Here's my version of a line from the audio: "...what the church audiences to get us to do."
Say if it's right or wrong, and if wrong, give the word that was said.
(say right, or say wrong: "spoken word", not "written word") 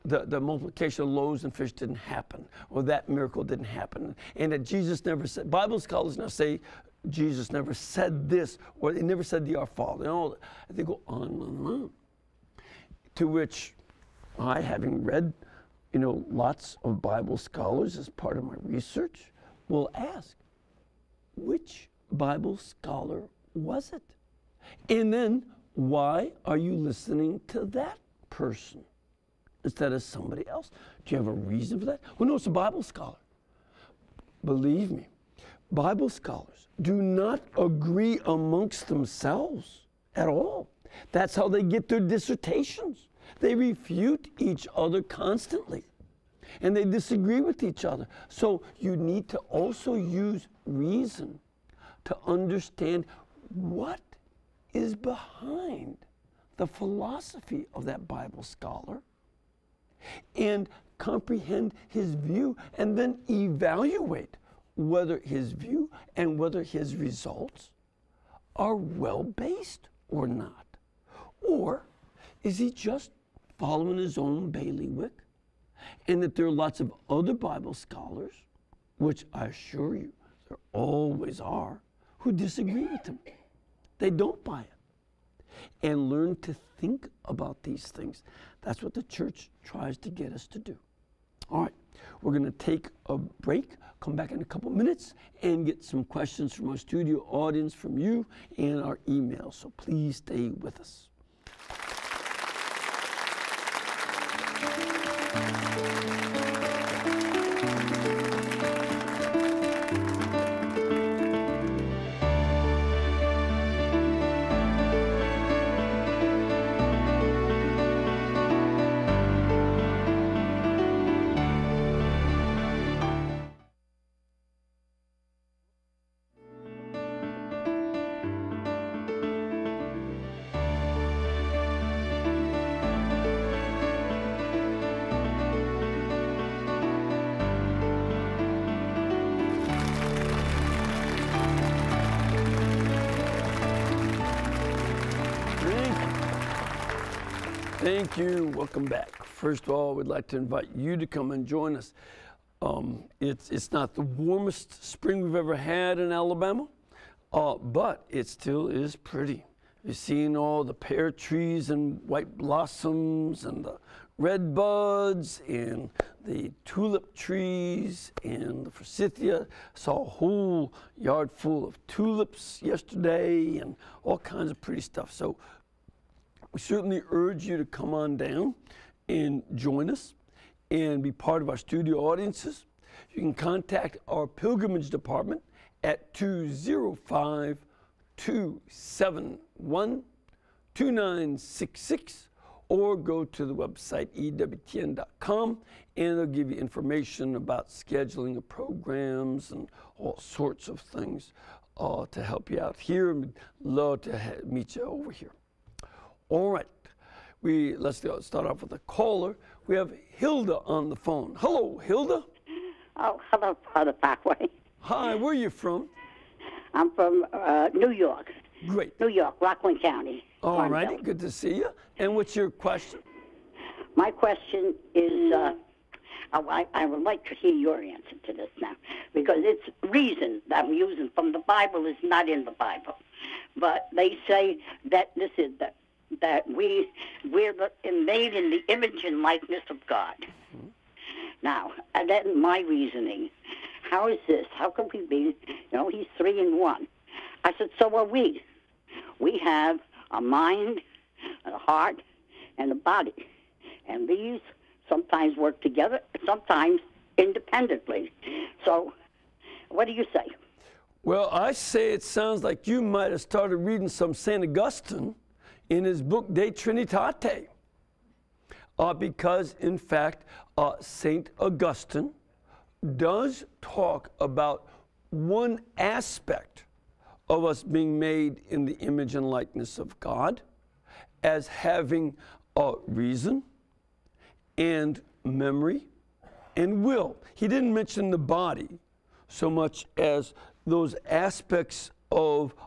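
wrong: "tries", not "audiences".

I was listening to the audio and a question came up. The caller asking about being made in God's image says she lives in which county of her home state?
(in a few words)
Rockland County.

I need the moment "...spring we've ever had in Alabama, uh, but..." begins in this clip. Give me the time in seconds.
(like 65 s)
154 s.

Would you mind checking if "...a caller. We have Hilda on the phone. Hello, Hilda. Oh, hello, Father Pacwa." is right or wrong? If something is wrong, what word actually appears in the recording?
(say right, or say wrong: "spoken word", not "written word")
right.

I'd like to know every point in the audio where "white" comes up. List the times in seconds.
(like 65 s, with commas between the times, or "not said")
162 s.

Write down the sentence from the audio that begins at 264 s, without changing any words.
Augustine in his book De Trinitate.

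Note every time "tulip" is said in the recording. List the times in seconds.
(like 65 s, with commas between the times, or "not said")
166 s, 171 s.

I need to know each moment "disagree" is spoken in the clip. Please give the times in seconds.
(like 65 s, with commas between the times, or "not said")
46 s, 82 s.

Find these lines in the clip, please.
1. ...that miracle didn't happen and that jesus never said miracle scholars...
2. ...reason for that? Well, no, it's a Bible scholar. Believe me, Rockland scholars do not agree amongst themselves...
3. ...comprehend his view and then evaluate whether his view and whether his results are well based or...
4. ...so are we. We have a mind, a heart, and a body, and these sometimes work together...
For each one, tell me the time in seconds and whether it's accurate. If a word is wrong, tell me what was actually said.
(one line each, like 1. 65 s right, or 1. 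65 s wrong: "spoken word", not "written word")
1. 2 s wrong: "bible", not "miracle"
2. 31 s wrong: "Bible", not "Rockland"
3. 60 s right
4. 247 s right.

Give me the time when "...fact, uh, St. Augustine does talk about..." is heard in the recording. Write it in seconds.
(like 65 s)
269 s.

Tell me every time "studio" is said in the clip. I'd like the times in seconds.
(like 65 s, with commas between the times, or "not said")
96 s, 181 s.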